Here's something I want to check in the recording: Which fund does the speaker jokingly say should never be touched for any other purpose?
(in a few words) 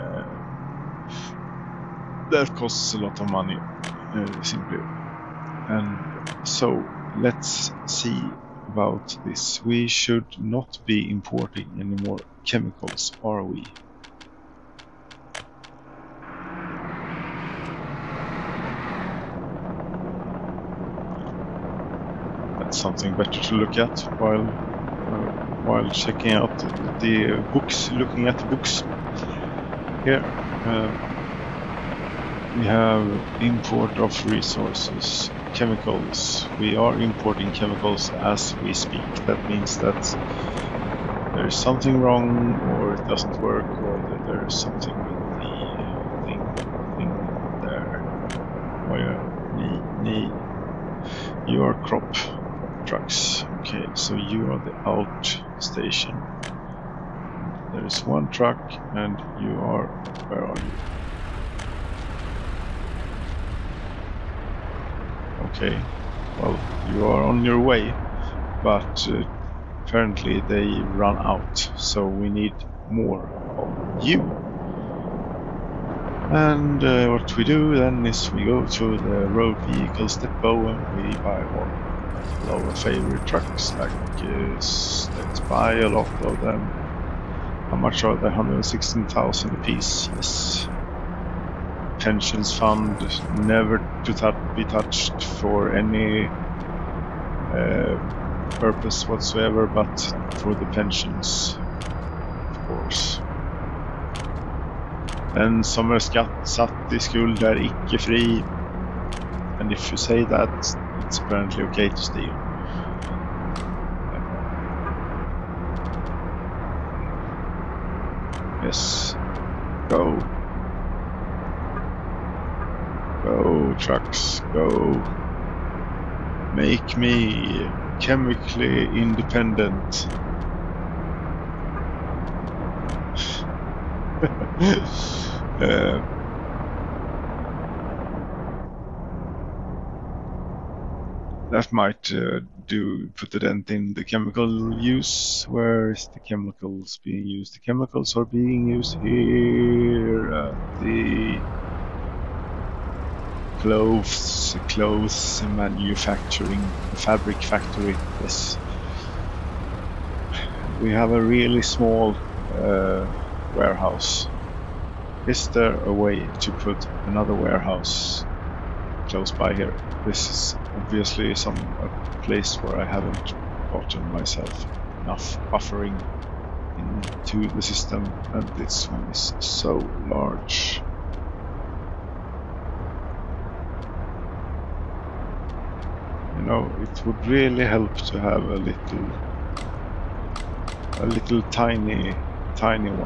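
Pensions Fund.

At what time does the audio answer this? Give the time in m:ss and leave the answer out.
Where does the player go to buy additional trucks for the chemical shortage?
1:19.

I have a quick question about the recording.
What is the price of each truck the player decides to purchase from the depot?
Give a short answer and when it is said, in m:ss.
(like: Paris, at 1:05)
116,000, at 1:28.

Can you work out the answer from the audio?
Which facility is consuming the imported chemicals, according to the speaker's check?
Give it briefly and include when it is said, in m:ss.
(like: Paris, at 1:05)
fabric factory, at 2:36.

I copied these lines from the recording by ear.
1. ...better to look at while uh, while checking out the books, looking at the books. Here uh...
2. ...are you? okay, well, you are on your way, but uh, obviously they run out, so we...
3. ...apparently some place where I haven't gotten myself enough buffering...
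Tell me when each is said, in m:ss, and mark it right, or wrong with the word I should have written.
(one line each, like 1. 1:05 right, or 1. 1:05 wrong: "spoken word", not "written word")
1. 0:23 right
2. 1:00 wrong: "apparently", not "obviously"
3. 2:50 wrong: "obviously", not "apparently".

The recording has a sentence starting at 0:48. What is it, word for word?
Where oh, need You your crop trucks.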